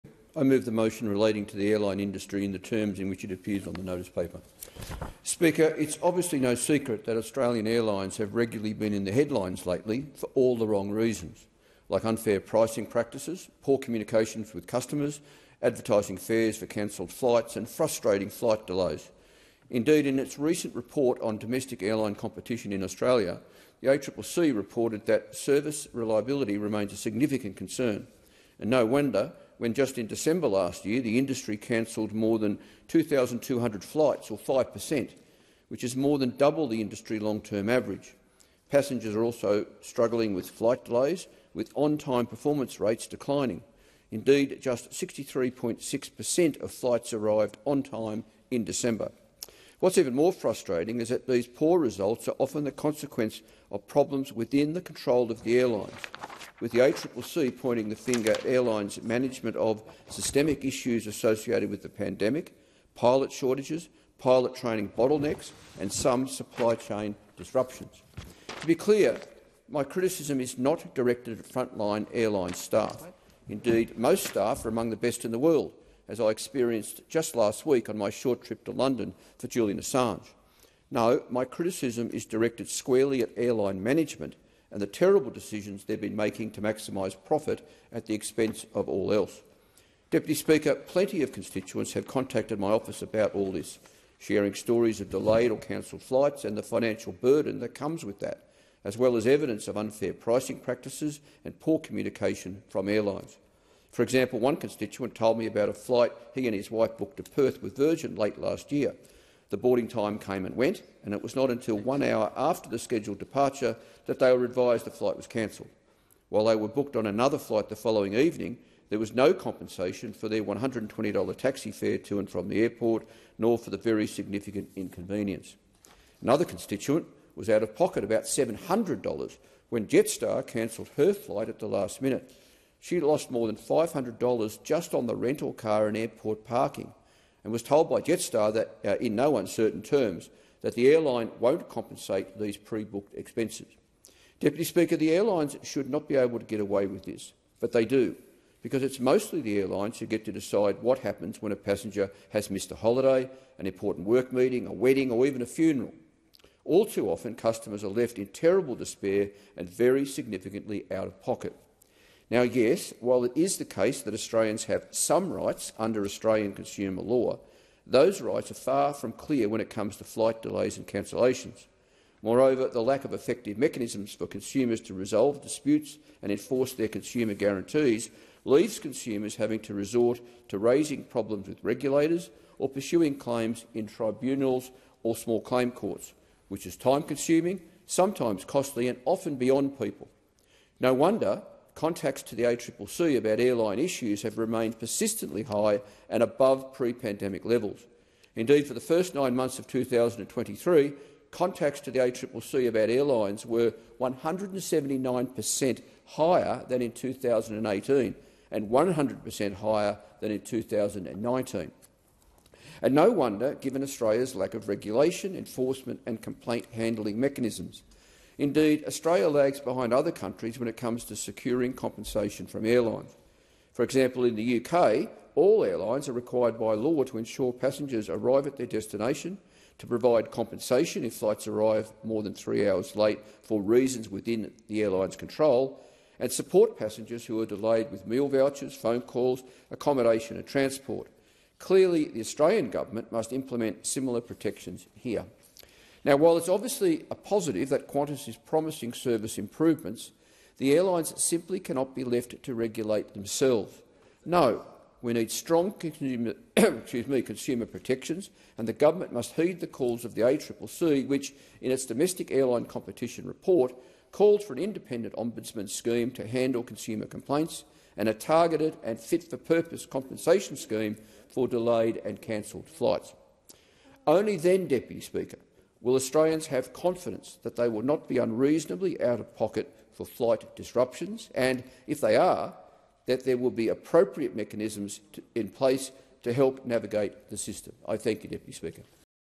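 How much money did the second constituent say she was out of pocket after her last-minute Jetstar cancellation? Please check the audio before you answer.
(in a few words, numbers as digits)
$700.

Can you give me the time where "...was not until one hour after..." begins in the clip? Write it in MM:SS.
01:51.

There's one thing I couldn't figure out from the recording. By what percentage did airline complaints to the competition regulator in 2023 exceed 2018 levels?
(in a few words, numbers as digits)
179 per cent.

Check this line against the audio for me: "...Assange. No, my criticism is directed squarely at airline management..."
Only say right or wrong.
right.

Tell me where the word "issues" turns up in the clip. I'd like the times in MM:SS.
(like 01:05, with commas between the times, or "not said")
01:00, 03:13.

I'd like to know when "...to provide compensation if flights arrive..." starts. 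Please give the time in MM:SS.
03:49.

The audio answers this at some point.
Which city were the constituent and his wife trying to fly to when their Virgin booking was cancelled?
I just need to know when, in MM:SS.
01:47.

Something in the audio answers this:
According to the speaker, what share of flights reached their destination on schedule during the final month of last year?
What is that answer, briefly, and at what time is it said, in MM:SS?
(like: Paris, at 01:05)
63.6 per cent, at 00:44.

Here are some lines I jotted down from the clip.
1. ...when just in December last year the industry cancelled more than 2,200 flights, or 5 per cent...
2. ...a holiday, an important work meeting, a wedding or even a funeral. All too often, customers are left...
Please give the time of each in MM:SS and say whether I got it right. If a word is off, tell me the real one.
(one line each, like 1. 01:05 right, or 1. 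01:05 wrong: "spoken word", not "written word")
1. 00:29 right
2. 02:32 right.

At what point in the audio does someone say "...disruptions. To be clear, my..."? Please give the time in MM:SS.
01:07.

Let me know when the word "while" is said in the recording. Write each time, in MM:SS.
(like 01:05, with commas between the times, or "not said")
01:56, 02:43, 04:06.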